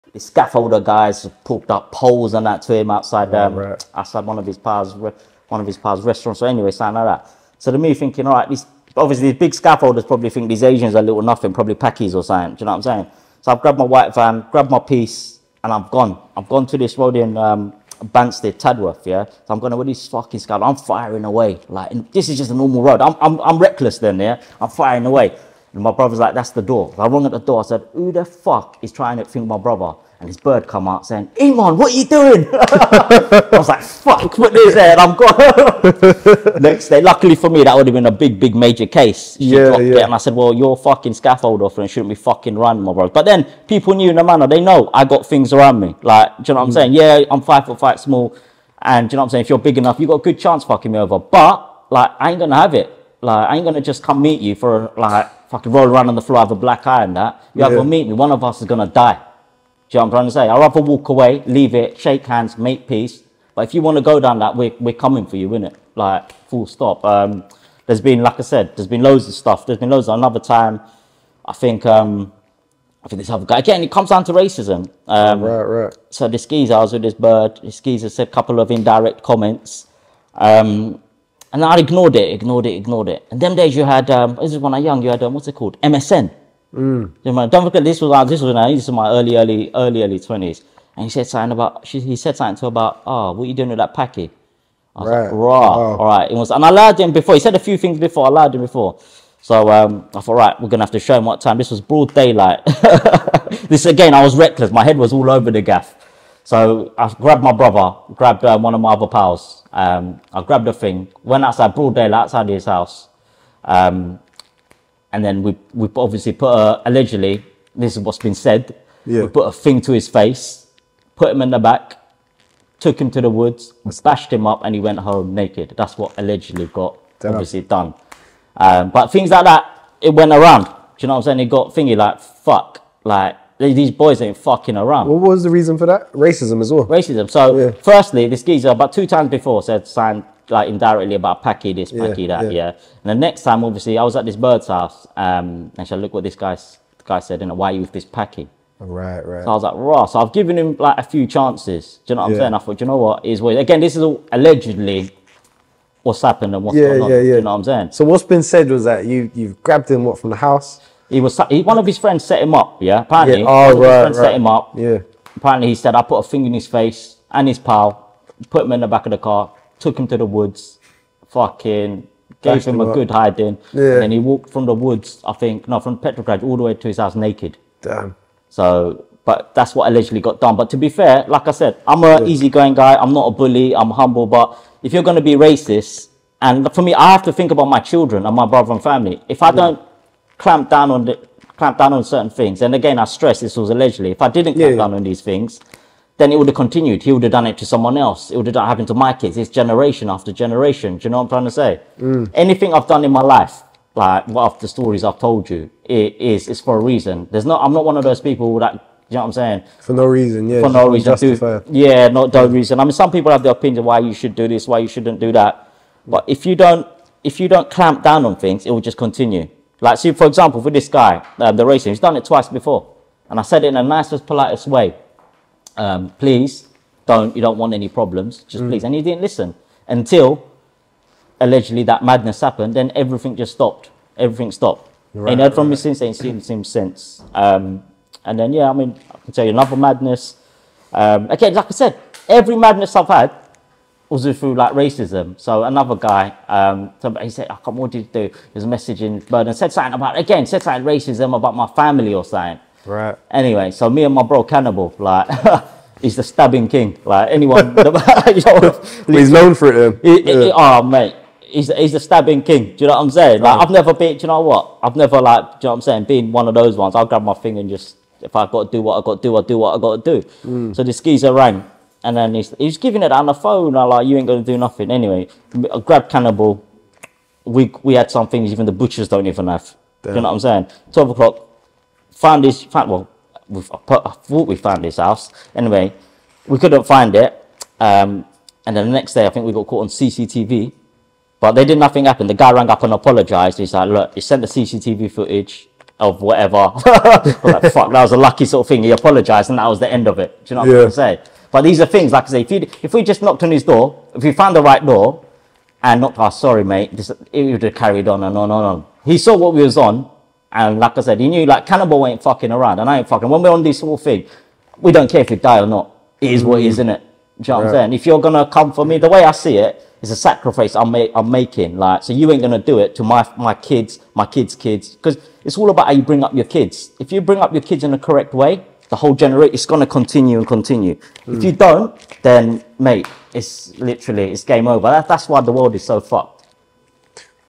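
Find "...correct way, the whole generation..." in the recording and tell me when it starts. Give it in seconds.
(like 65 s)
327 s.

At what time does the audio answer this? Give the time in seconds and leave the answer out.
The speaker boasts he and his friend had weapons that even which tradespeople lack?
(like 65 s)
278 s.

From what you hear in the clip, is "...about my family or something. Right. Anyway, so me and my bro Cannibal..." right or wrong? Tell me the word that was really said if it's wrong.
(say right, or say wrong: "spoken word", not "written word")
right.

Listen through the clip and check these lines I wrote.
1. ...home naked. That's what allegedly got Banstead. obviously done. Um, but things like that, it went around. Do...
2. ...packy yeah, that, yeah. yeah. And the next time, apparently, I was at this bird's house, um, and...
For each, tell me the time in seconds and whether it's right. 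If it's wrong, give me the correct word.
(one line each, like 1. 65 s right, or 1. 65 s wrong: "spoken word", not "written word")
1. 124 s wrong: "Damn", not "Banstead"
2. 141 s wrong: "obviously", not "apparently".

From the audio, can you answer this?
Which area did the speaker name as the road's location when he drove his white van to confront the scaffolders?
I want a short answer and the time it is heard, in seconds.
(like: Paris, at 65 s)
Banstead, at 18 s.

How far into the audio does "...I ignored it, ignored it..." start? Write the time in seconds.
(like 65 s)
81 s.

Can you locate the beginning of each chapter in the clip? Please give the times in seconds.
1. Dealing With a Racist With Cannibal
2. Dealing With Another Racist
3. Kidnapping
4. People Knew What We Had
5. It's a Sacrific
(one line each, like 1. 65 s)
1. 242 s
2. 75 s
3. 120 s
4. 43 s
5. 316 s.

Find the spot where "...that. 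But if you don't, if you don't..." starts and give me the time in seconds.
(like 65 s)
215 s.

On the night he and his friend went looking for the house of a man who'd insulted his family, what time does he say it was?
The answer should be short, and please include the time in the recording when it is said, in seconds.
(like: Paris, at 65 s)
12 o'clock, at 280 s.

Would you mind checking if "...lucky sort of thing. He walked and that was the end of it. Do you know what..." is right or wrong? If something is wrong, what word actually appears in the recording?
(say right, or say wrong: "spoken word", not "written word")
wrong: "apologized", not "walked".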